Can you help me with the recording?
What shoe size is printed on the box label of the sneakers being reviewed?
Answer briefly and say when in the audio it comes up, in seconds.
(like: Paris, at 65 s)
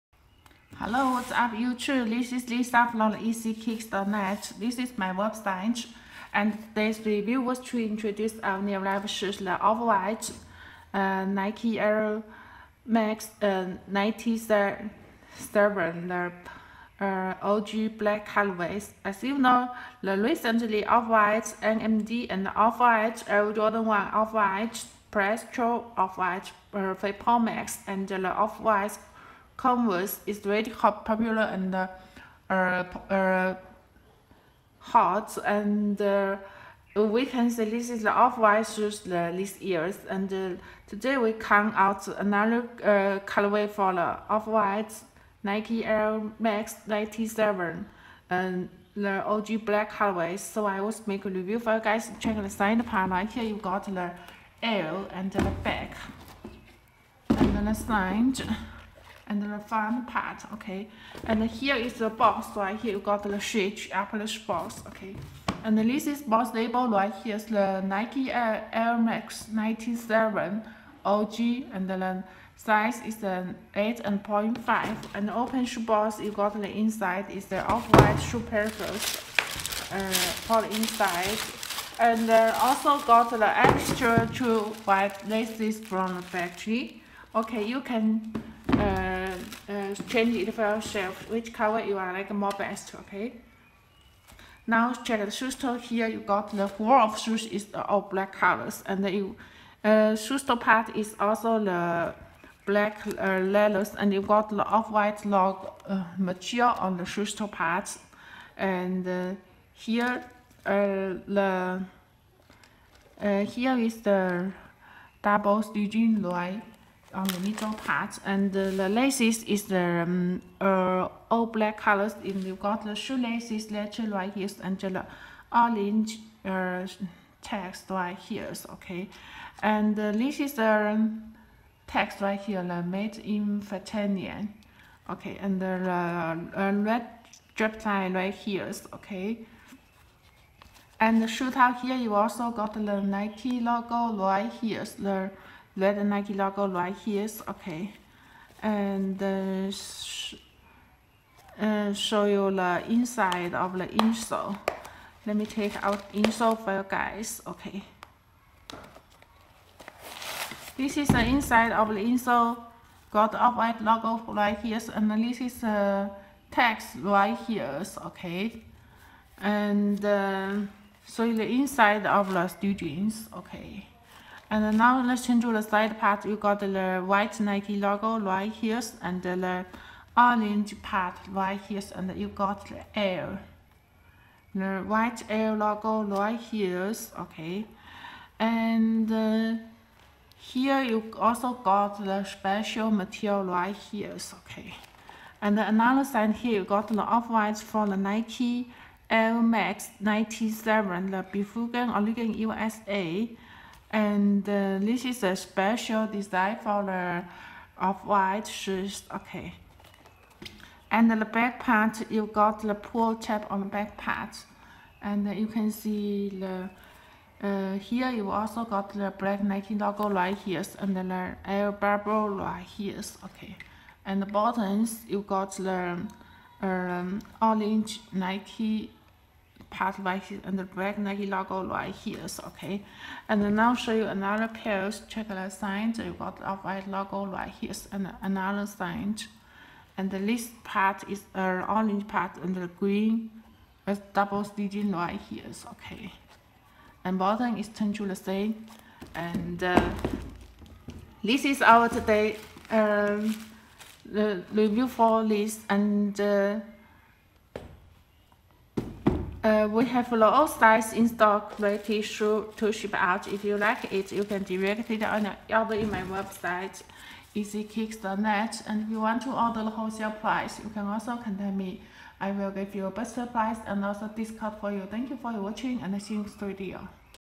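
8.5, at 73 s.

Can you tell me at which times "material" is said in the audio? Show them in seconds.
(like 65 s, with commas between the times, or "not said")
106 s, 192 s.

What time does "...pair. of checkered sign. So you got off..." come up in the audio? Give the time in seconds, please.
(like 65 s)
234 s.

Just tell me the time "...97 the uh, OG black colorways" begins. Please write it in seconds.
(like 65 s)
13 s.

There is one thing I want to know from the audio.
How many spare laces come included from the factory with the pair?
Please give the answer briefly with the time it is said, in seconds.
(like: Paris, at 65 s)
2, at 84 s.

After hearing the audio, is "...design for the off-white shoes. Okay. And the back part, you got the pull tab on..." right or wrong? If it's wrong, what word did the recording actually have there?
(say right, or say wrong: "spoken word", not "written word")
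right.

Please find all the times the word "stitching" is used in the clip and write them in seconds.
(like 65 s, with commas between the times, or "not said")
115 s, 244 s.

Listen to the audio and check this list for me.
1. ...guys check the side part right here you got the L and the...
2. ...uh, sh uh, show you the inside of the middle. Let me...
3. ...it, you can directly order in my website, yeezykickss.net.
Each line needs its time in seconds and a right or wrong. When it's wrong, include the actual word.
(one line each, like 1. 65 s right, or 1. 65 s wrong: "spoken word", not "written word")
1. 51 s right
2. 149 s wrong: "insole", not "middle"
3. 263 s right.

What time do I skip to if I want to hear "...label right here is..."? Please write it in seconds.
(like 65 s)
66 s.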